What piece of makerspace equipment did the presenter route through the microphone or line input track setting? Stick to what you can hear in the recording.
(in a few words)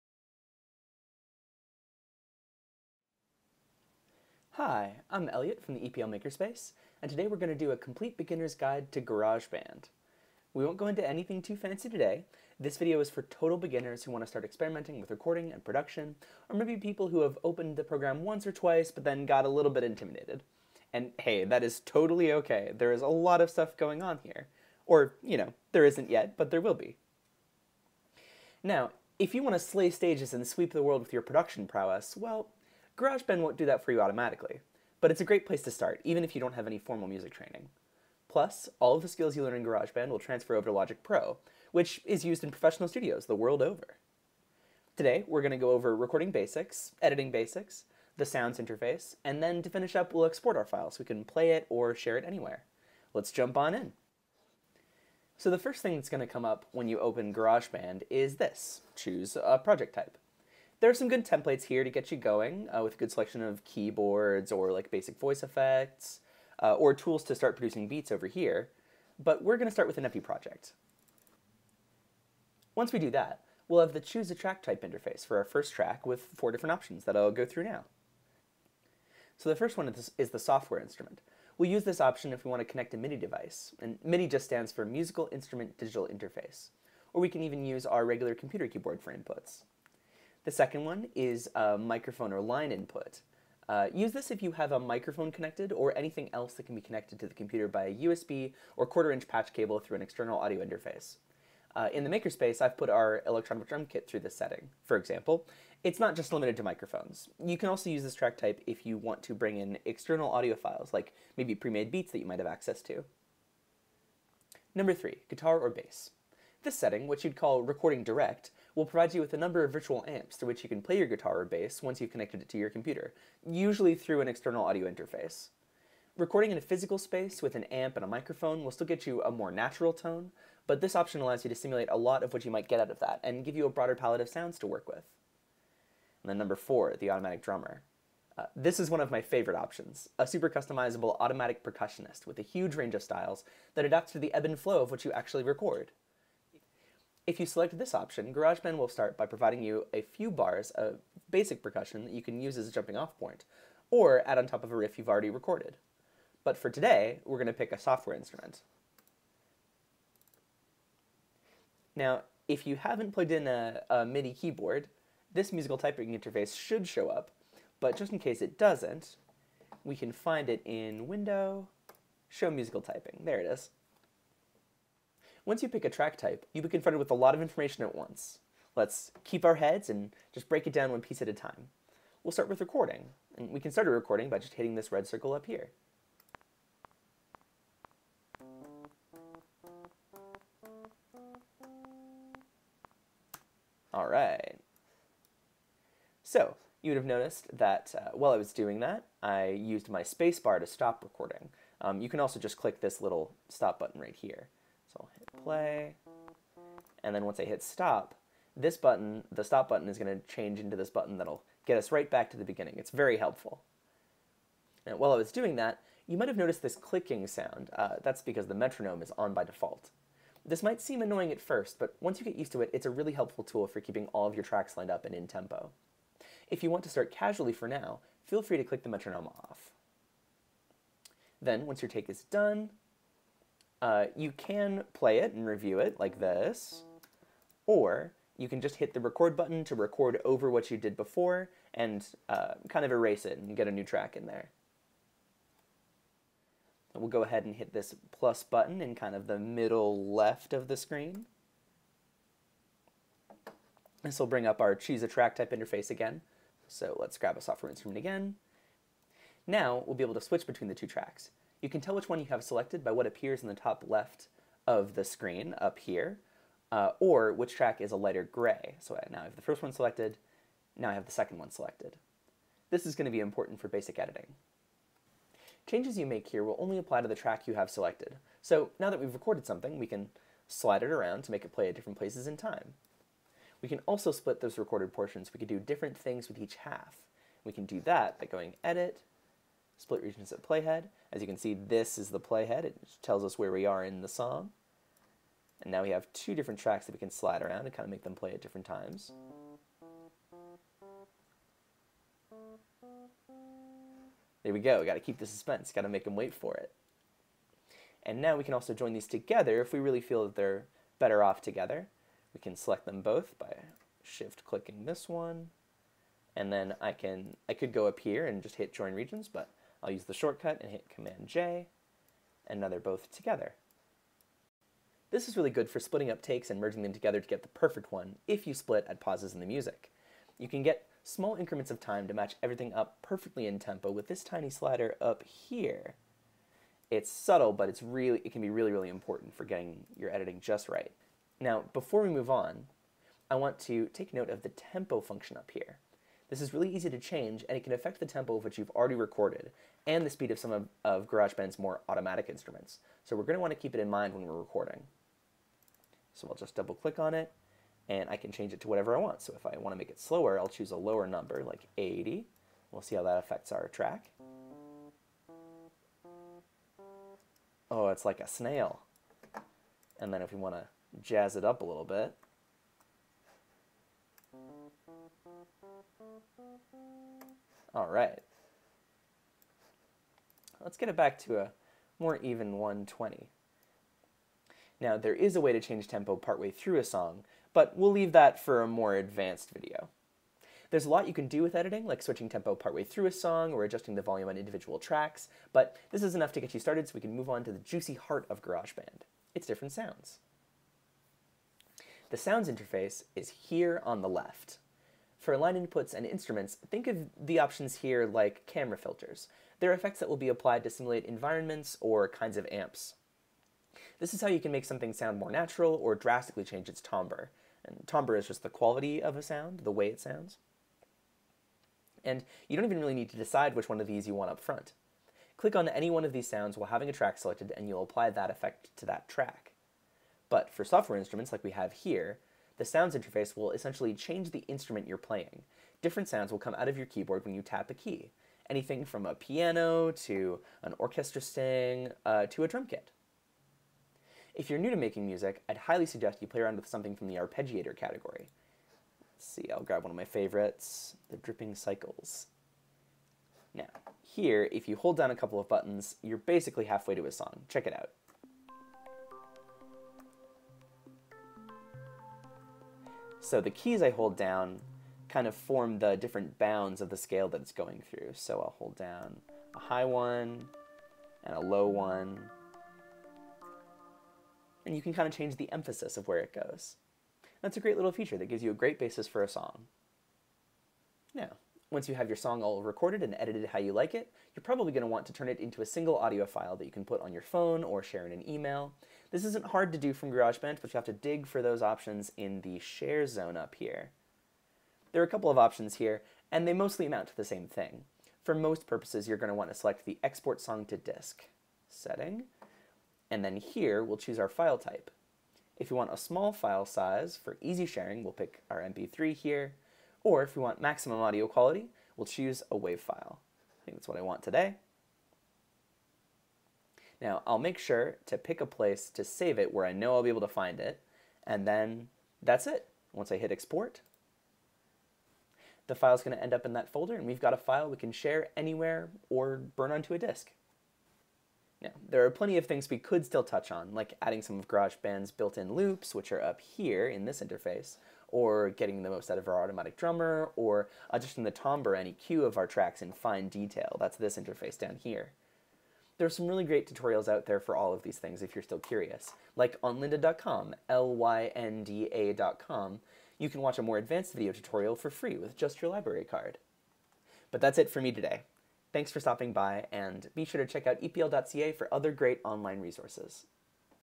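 electronic drum kit.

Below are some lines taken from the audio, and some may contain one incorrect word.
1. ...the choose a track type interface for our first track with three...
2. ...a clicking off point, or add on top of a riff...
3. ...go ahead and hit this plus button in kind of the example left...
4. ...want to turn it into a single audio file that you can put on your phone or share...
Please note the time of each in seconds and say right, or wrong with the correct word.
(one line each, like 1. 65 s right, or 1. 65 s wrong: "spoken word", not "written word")
1. 73 s wrong: "four", not "three"
2. 152 s wrong: "jumping", not "clicking"
3. 247 s wrong: "middle", not "example"
4. 484 s right.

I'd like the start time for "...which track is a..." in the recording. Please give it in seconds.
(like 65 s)
267 s.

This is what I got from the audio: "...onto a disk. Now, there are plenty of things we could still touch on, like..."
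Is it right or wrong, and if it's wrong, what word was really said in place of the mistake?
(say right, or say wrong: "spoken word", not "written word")
right.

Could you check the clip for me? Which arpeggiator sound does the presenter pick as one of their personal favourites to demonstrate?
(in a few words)
Dripping Cycles.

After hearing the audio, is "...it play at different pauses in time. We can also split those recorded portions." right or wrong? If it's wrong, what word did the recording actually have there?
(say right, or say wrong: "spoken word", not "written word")
wrong: "places", not "pauses".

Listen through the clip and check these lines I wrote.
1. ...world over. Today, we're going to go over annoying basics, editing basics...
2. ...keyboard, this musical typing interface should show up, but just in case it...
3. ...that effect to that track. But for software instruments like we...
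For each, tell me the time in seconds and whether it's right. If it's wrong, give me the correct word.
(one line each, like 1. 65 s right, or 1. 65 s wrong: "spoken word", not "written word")
1. 43 s wrong: "recording", not "annoying"
2. 164 s right
3. 428 s right.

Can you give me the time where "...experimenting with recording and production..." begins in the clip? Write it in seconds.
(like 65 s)
14 s.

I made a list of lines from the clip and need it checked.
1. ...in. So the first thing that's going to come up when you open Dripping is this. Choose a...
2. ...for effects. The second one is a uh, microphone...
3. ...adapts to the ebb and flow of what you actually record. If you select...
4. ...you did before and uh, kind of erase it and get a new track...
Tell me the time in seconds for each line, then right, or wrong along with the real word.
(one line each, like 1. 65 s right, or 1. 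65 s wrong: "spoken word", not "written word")
1. 53 s wrong: "GarageBand", not "Dripping"
2. 88 s wrong: "inputs", not "effects"
3. 143 s right
4. 240 s right.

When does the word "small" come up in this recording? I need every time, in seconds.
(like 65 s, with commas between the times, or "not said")
331 s, 505 s.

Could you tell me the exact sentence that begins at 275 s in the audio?
Changes you make here will only apply to the track you have selected.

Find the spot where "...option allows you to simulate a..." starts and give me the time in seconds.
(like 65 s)
130 s.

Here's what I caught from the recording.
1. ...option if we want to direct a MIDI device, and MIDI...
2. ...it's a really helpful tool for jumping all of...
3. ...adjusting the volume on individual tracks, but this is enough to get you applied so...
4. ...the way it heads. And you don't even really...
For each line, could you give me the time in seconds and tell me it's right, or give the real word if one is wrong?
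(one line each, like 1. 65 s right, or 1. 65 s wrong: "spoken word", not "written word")
1. 82 s wrong: "connect", not "direct"
2. 222 s wrong: "keeping", not "jumping"
3. 393 s wrong: "started", not "applied"
4. 419 s wrong: "sounds", not "heads".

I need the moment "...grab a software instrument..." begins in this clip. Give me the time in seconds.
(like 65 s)
257 s.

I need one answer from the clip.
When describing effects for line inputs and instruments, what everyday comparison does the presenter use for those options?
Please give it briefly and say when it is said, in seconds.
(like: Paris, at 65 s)
camera filters, at 408 s.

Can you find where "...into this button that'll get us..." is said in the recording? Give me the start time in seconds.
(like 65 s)
210 s.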